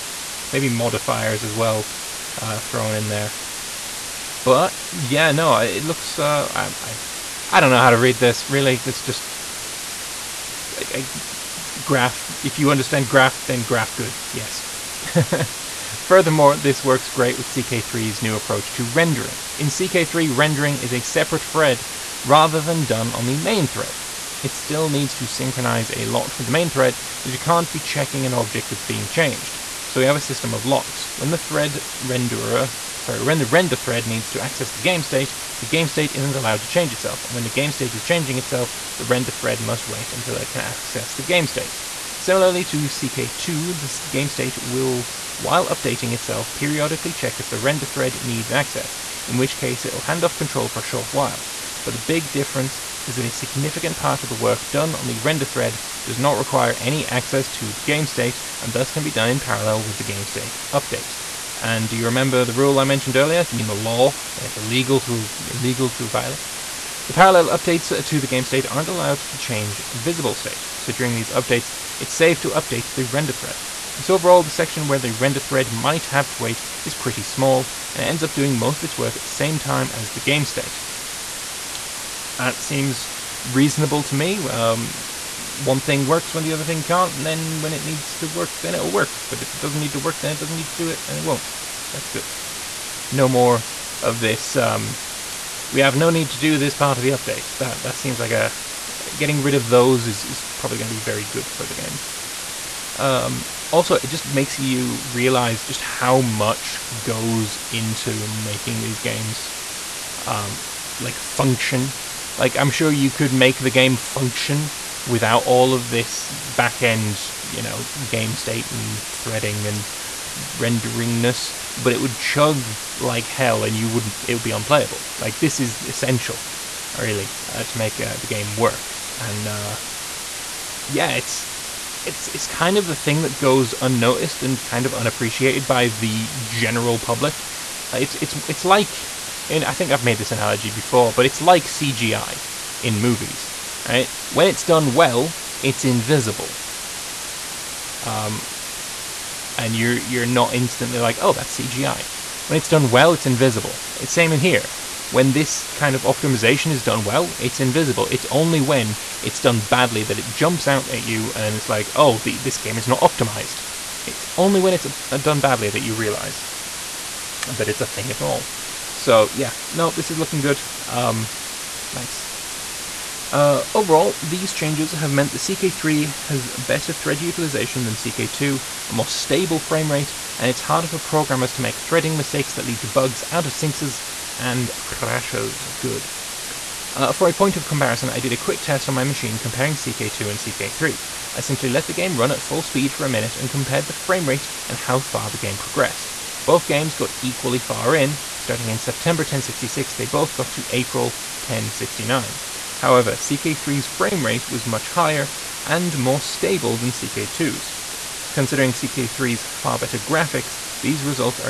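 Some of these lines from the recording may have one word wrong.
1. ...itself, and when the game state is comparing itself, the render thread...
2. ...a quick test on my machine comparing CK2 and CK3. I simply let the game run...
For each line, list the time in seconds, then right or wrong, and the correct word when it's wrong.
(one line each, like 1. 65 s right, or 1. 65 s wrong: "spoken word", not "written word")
1. 36 s wrong: "changing", not "comparing"
2. 188 s right.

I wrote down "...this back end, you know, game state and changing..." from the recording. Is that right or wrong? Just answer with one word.
wrong.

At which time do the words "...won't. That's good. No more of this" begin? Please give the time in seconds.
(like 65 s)
91 s.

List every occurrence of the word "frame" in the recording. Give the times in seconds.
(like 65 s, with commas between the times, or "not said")
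179 s, 193 s, 203 s.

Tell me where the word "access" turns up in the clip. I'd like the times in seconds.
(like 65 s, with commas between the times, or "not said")
34 s, 40 s, 48 s, 57 s.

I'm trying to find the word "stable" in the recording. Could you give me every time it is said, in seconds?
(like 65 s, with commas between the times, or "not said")
179 s, 206 s.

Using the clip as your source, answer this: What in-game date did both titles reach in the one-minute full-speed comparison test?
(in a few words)
April 1069.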